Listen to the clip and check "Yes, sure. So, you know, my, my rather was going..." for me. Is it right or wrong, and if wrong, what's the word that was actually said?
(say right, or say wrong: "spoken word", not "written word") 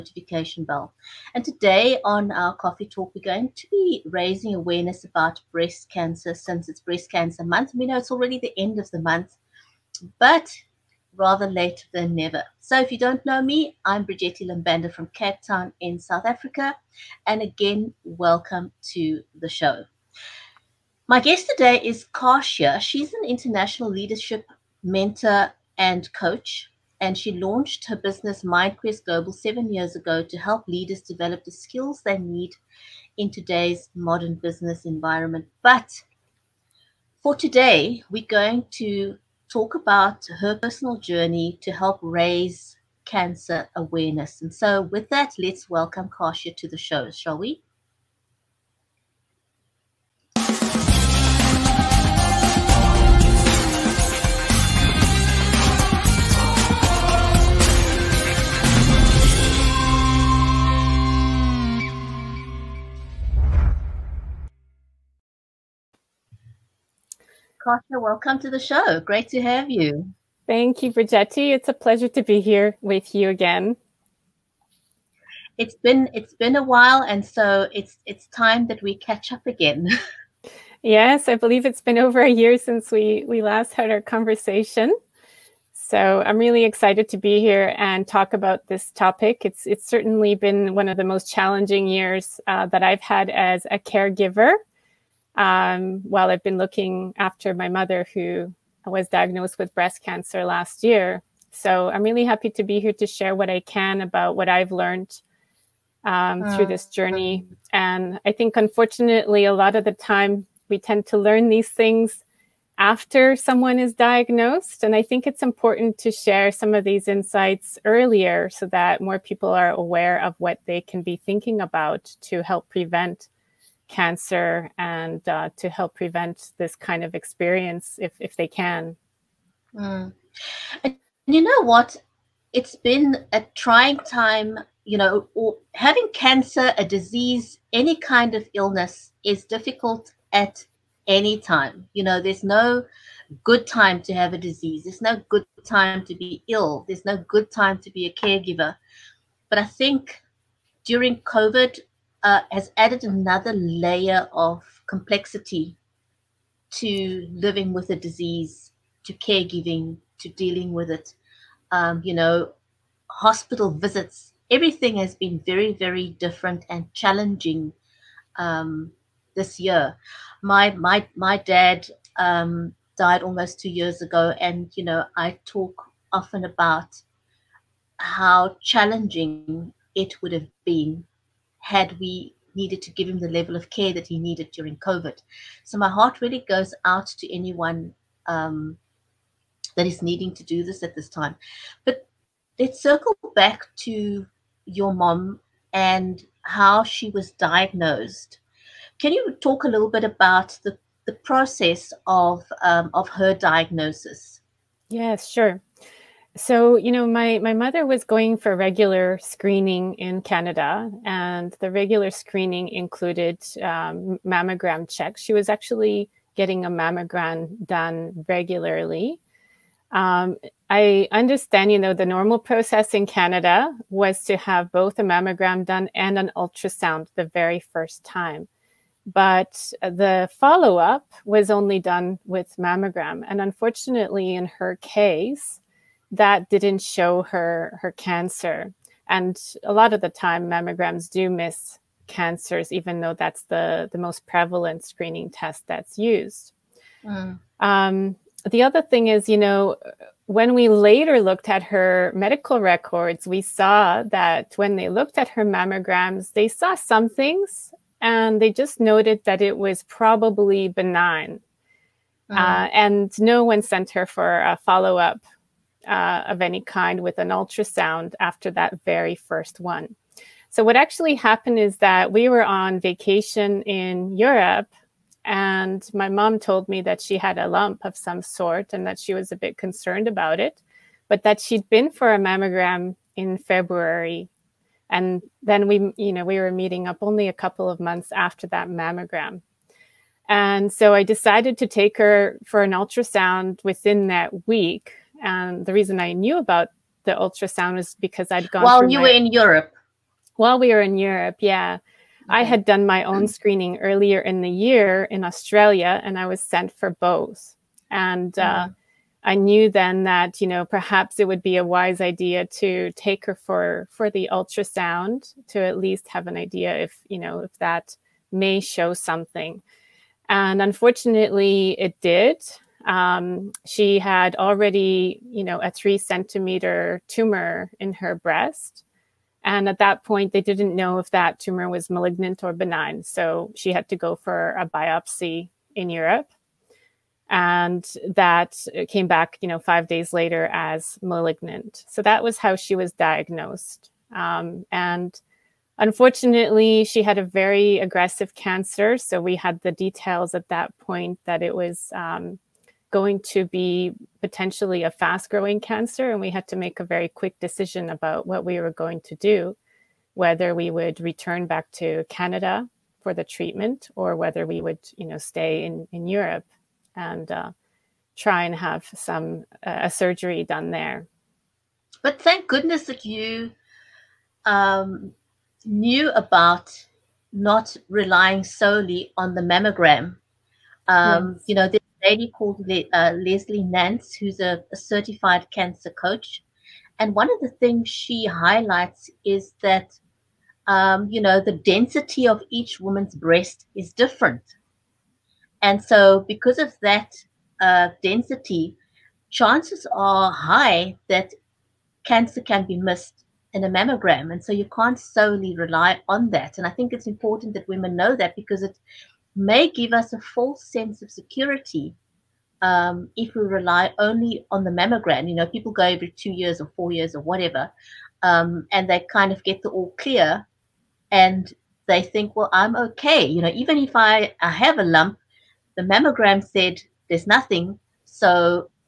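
wrong: "mother", not "rather".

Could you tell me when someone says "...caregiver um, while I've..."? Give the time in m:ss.
1:33.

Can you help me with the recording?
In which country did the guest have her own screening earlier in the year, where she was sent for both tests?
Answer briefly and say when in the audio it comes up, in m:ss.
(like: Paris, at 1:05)
Australia, at 5:05.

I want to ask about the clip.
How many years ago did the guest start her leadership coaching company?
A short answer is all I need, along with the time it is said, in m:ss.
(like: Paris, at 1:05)
7, at 0:29.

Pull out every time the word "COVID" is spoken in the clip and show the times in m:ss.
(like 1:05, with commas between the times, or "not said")
2:31, 3:04.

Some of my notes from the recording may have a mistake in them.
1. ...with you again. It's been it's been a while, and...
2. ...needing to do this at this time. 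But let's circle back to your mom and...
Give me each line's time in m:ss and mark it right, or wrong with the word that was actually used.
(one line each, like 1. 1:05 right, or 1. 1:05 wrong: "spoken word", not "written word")
1. 1:12 right
2. 3:10 right.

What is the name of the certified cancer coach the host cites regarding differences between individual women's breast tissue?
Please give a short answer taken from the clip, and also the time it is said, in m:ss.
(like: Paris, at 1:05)
Leslie Nance, at 6:23.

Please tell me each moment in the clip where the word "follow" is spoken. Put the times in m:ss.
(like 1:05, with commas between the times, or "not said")
3:50, 4:24.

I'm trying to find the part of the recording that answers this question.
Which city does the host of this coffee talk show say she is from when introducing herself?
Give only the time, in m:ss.
0:15.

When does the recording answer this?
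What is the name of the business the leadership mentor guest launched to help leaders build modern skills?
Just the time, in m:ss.
0:28.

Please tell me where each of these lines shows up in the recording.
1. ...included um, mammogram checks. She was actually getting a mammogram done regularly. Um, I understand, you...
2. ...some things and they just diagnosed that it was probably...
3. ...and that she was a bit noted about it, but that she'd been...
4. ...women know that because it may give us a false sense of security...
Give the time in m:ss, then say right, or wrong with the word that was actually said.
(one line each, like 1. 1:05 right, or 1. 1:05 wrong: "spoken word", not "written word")
1. 3:32 right
2. 4:16 wrong: "noted", not "diagnosed"
3. 4:38 wrong: "concerned", not "noted"
4. 6:47 right.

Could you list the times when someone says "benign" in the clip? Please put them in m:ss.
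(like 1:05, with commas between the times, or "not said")
4:20, 5:32.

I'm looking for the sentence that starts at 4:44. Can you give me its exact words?
And then we, you know, we were meeting up only a couple of months after that mammogram.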